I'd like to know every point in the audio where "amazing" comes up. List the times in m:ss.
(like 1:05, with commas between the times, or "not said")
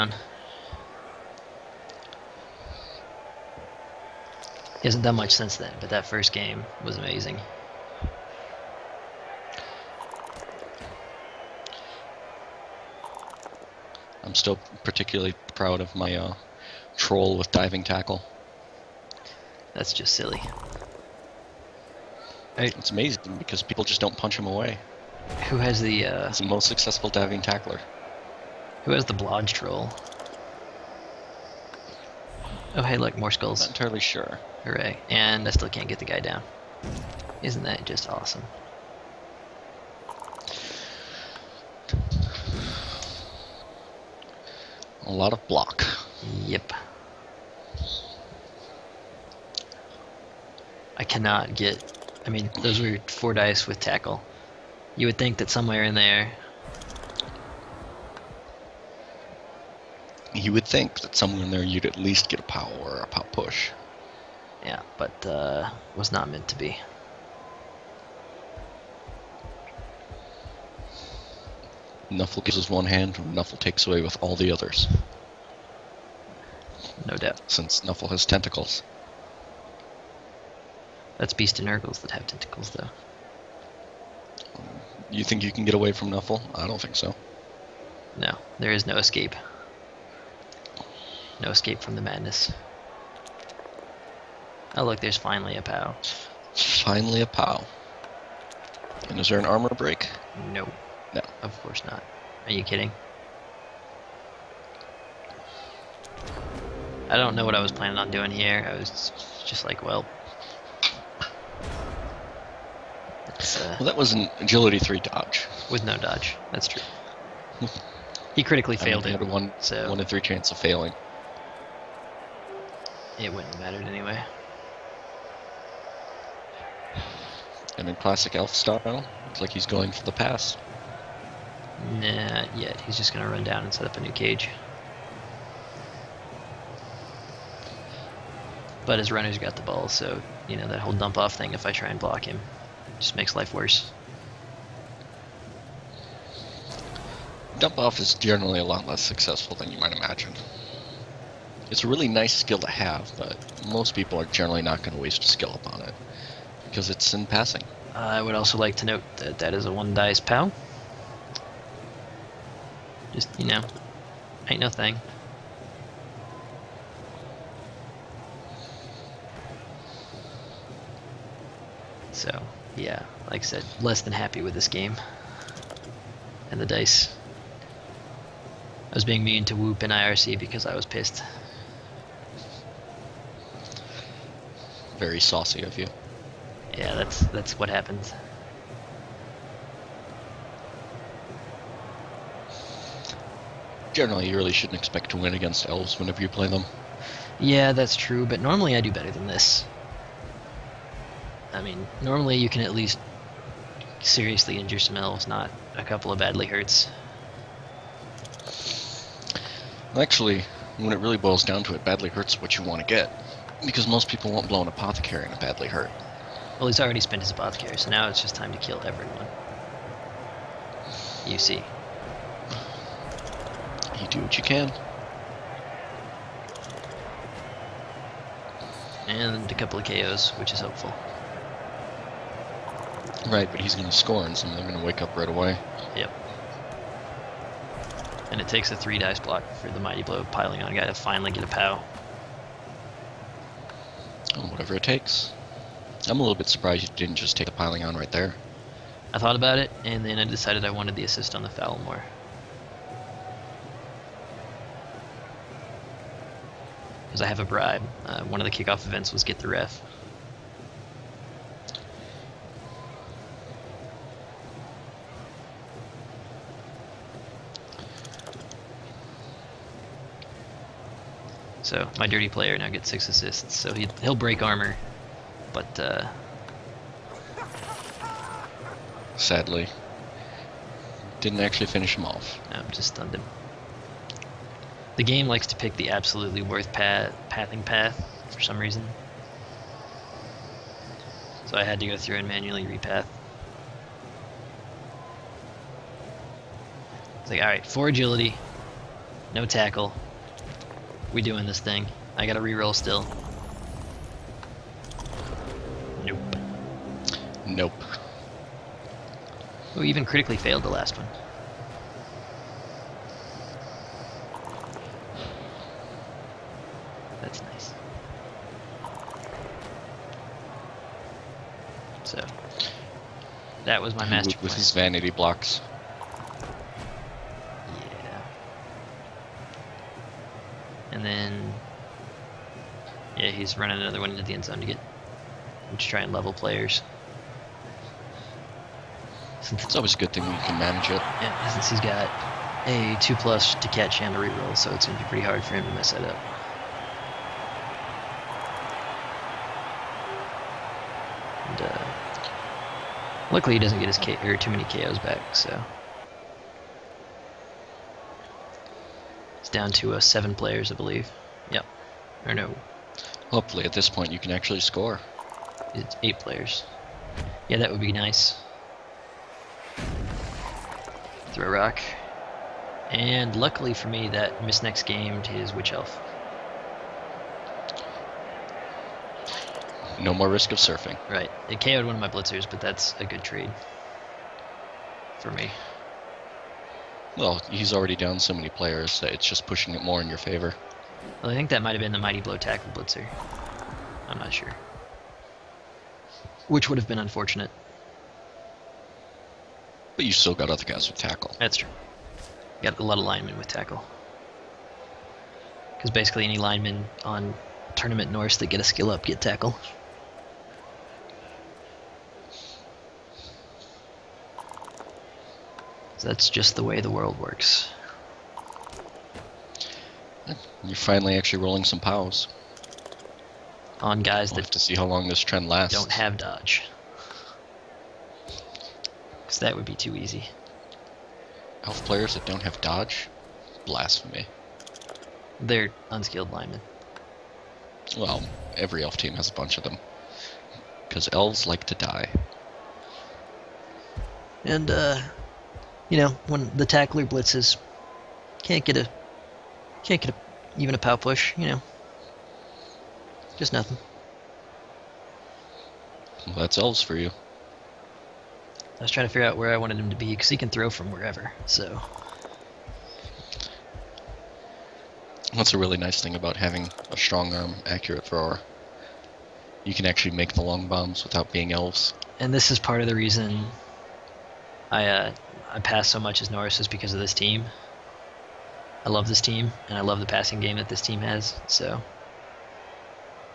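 0:06, 0:22.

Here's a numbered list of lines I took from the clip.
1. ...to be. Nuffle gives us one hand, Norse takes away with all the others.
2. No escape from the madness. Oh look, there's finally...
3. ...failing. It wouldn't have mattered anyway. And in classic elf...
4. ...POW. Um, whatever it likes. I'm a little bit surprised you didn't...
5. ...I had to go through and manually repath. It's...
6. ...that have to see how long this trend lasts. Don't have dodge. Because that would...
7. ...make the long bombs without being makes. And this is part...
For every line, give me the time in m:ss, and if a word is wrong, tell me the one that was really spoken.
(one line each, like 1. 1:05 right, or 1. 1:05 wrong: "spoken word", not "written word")
1. 1:06 wrong: "Nuffle", not "Norse"
2. 1:31 right
3. 2:00 right
4. 4:01 wrong: "takes", not "likes"
5. 4:51 right
6. 7:04 right
7. 7:50 wrong: "elves", not "makes".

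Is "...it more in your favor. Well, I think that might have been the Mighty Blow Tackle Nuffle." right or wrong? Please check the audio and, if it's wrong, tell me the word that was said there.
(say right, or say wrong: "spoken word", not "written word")
wrong: "Blitzer", not "Nuffle".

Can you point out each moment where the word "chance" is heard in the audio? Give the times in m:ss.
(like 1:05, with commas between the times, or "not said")
2:00.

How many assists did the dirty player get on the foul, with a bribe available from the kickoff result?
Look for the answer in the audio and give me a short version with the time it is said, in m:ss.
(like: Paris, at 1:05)
6, at 4:32.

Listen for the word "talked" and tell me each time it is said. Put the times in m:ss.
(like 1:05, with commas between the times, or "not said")
not said.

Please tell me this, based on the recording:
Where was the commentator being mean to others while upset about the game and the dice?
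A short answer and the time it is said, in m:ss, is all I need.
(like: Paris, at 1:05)
IRC, at 2:59.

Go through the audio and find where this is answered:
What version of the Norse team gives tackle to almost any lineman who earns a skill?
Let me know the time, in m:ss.
6:47.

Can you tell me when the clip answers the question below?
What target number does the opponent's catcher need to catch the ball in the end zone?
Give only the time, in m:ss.
5:43.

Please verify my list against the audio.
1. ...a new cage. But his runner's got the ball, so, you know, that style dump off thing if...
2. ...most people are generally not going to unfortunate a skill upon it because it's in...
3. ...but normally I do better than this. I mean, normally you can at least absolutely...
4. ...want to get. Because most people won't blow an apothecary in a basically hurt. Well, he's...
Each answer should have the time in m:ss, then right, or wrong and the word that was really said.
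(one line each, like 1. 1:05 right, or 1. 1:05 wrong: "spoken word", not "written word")
1. 2:13 wrong: "whole", not "style"
2. 2:33 wrong: "waste", not "unfortunate"
3. 3:18 wrong: "seriously", not "absolutely"
4. 3:32 wrong: "badly", not "basically".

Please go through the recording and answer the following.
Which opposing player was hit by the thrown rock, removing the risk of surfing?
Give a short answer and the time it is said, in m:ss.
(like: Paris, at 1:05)
Witch Elf, at 6:15.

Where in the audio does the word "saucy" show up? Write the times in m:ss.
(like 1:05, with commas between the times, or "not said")
3:05.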